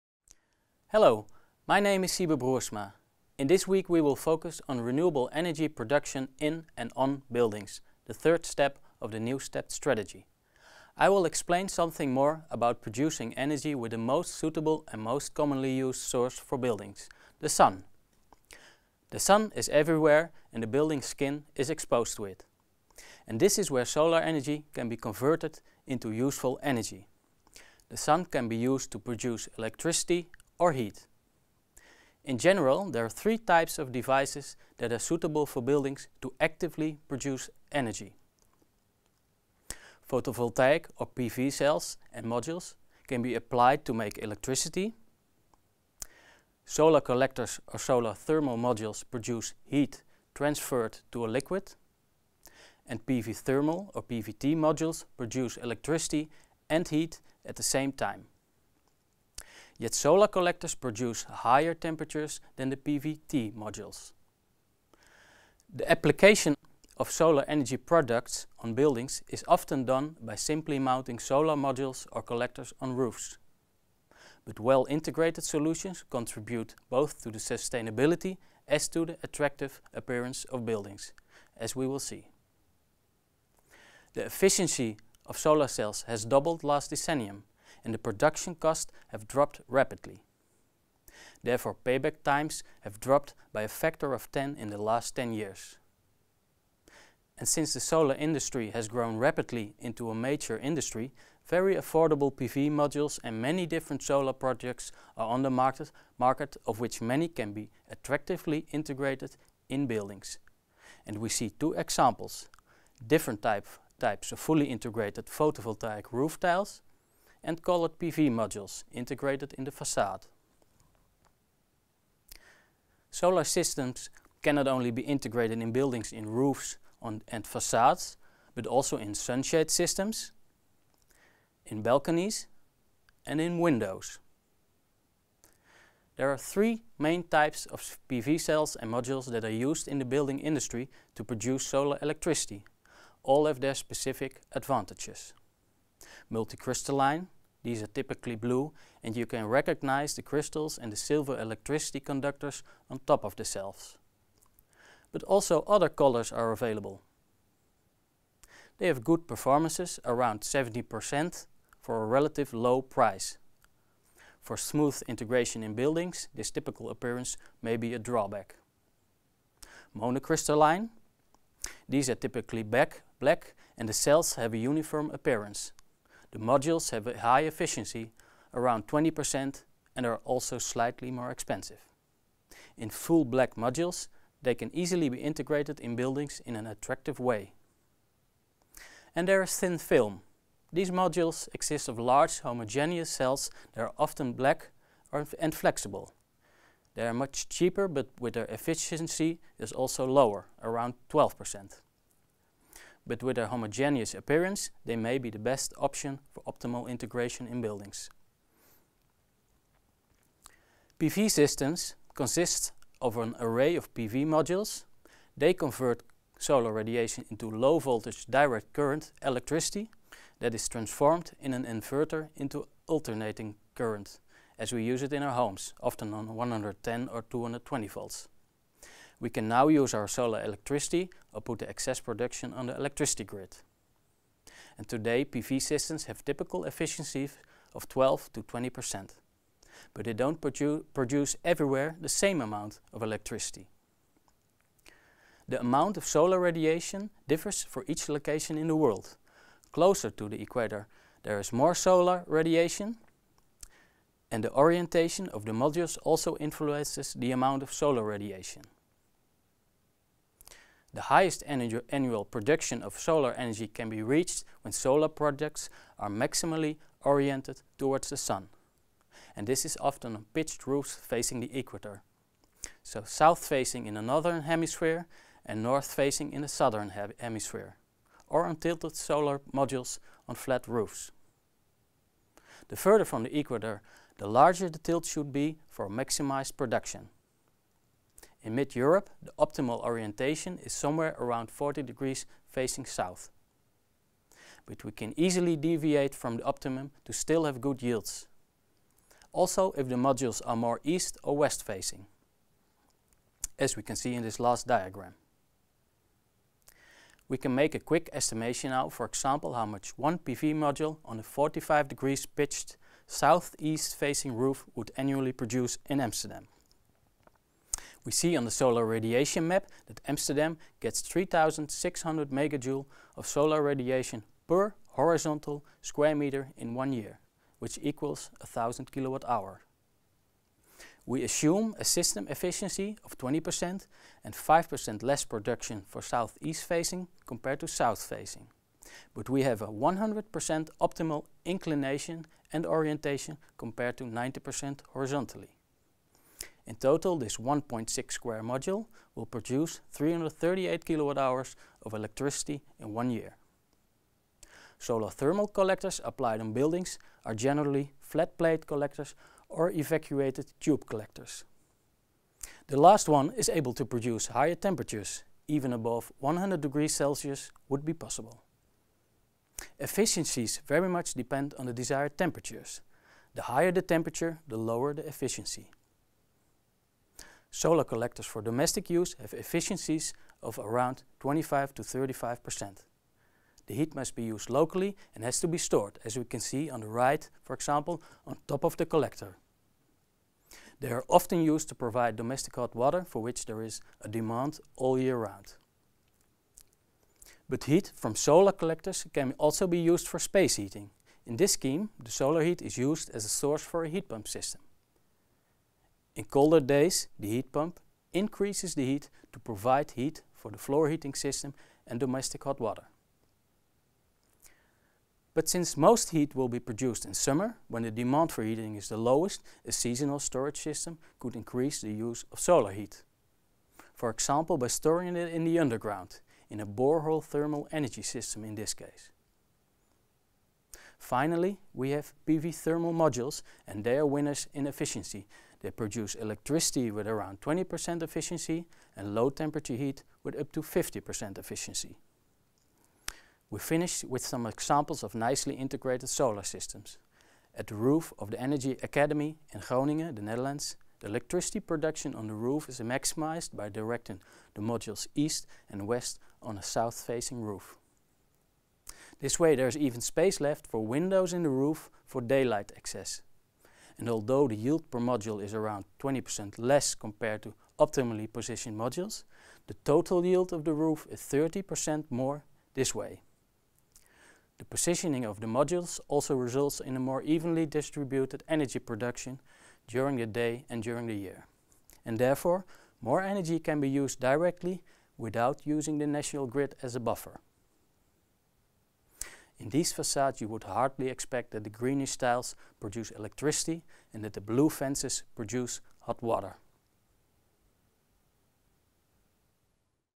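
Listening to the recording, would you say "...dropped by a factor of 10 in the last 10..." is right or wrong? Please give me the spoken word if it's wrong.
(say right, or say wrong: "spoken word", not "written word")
right.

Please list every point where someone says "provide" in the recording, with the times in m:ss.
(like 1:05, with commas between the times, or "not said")
6:31, 6:49.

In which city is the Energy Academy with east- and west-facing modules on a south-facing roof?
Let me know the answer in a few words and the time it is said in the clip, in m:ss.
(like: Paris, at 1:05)
Groningen, at 7:29.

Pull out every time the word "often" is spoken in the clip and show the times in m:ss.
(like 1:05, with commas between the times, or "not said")
1:09, 3:13, 3:45, 4:29, 6:31.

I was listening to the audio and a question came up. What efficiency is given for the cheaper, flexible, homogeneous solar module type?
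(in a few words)
12%.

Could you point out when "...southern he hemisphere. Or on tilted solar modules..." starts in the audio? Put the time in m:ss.
4:36.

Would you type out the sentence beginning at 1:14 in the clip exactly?
But well-integrated solutions contribute both to the sustainability as to the attractive appearance of buildings, as we will see.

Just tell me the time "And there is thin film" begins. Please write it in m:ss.
3:09.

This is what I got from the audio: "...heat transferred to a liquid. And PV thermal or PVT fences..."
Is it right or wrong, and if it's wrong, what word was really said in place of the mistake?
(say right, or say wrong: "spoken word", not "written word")
wrong: "modules", not "fences".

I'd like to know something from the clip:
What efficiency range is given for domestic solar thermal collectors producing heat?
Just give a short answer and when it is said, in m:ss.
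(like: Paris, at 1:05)
25 to 35 percent, at 6:21.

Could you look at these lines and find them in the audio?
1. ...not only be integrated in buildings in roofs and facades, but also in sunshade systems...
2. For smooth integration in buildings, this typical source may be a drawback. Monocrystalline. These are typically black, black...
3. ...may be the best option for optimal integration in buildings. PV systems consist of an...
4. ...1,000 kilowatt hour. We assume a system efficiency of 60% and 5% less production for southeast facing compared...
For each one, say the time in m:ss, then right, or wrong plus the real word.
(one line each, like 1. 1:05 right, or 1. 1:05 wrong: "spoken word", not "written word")
1. 2:04 right
2. 2:44 wrong: "appearance", not "source"
3. 3:24 right
4. 5:28 wrong: "20", not "60".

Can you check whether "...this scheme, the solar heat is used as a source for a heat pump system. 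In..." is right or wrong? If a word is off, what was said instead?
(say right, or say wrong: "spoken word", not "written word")
right.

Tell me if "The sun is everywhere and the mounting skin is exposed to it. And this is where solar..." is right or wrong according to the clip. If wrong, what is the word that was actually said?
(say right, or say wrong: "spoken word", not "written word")
wrong: "building", not "mounting".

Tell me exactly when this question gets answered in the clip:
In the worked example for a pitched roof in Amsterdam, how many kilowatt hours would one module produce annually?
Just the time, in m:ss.
5:49.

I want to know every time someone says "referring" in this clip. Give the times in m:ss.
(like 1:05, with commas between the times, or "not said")
not said.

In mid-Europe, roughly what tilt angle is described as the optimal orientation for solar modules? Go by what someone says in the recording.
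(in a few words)
40 degrees.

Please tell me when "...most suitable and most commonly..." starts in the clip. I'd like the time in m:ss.
0:13.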